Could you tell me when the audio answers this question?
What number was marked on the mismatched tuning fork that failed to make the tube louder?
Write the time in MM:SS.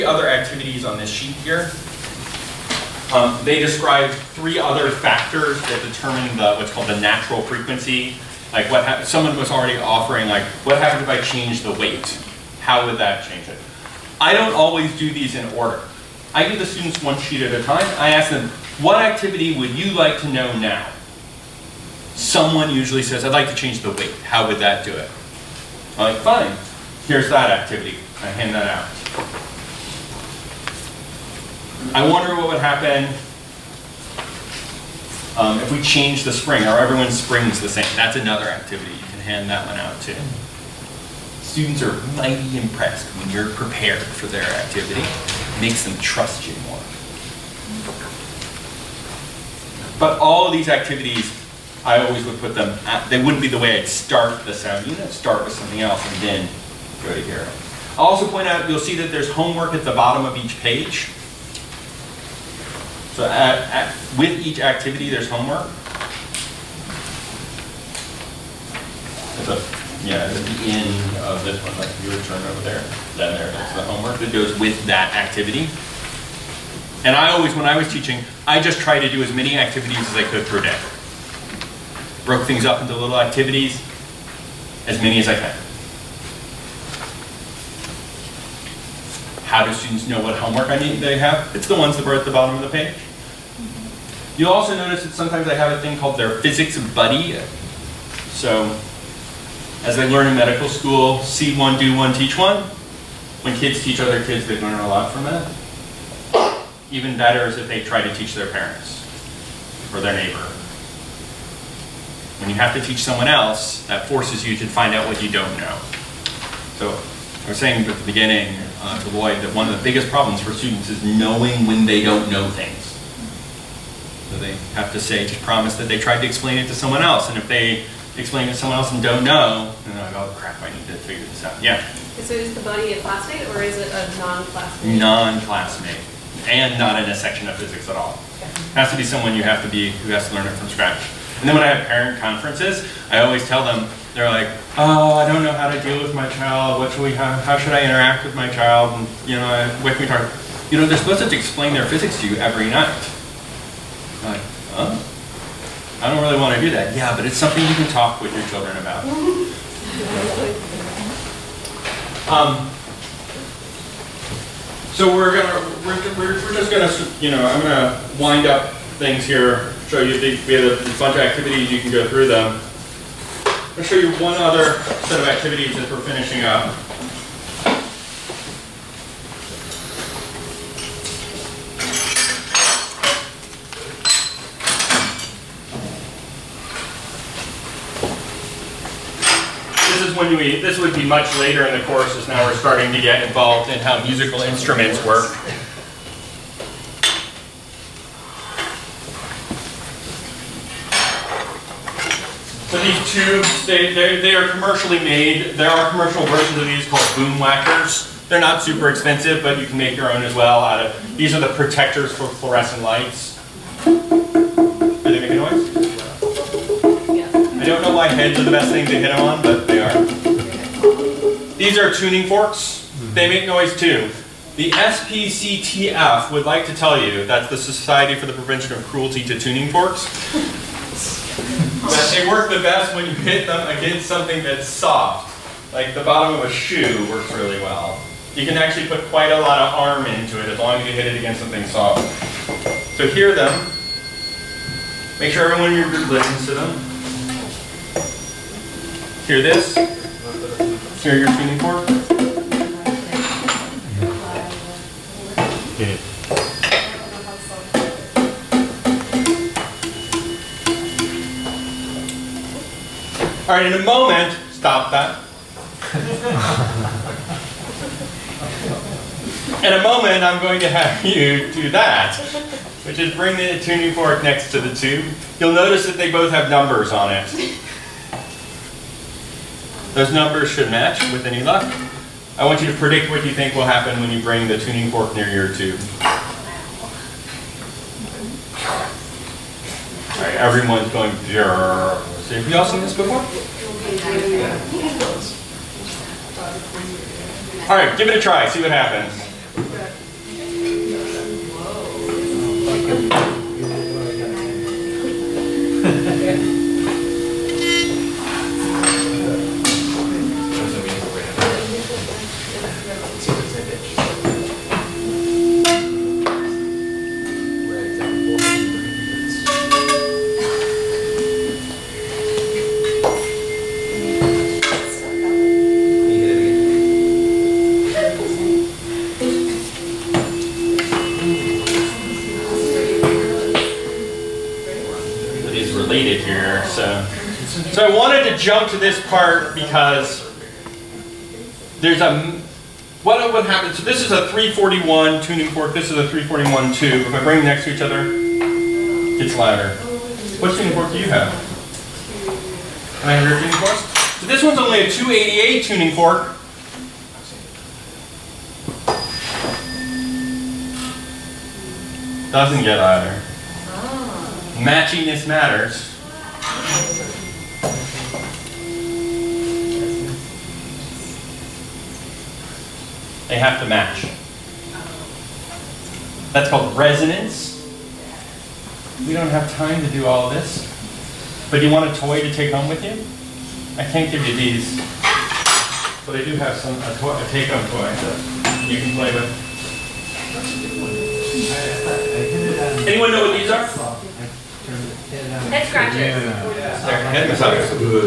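05:54.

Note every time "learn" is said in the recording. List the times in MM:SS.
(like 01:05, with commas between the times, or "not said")
01:40, 01:44, 02:20.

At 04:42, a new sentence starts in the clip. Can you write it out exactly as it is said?
I want you to predict what you think will happen when you bring the tuning fork near your tube.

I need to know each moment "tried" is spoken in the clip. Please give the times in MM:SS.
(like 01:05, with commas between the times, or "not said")
01:18, 02:05.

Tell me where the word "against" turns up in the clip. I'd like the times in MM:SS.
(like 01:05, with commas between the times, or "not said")
03:53, 04:01.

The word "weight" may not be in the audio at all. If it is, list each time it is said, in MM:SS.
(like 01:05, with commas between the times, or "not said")
00:11, 00:23.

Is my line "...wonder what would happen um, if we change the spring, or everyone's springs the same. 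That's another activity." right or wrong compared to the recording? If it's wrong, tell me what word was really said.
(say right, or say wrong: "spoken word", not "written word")
right.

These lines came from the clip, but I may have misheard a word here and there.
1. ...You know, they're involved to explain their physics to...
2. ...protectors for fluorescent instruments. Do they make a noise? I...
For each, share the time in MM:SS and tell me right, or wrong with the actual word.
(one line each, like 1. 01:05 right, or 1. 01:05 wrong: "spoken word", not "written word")
1. 02:30 wrong: "supposed", not "involved"
2. 03:31 wrong: "lights", not "instruments".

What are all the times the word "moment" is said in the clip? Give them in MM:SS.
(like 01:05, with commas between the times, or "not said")
04:23, 04:29.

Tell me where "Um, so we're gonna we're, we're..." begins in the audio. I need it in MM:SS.
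02:42.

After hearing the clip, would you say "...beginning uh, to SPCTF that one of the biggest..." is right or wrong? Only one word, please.
wrong.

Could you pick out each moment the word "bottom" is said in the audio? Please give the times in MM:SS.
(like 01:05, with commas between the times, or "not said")
00:59, 01:32, 03:56.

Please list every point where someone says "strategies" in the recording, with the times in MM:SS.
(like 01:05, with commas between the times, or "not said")
not said.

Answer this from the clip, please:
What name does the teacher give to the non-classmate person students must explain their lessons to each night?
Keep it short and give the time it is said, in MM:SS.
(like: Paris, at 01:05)
physics buddy, at 01:36.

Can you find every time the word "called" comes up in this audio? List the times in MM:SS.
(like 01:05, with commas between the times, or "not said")
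00:06, 01:35, 03:26, 06:16.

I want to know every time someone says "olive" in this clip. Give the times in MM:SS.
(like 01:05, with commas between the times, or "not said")
not said.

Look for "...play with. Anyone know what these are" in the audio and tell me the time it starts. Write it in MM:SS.
06:28.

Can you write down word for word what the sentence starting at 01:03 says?
So at, at, with each activity, there's homework.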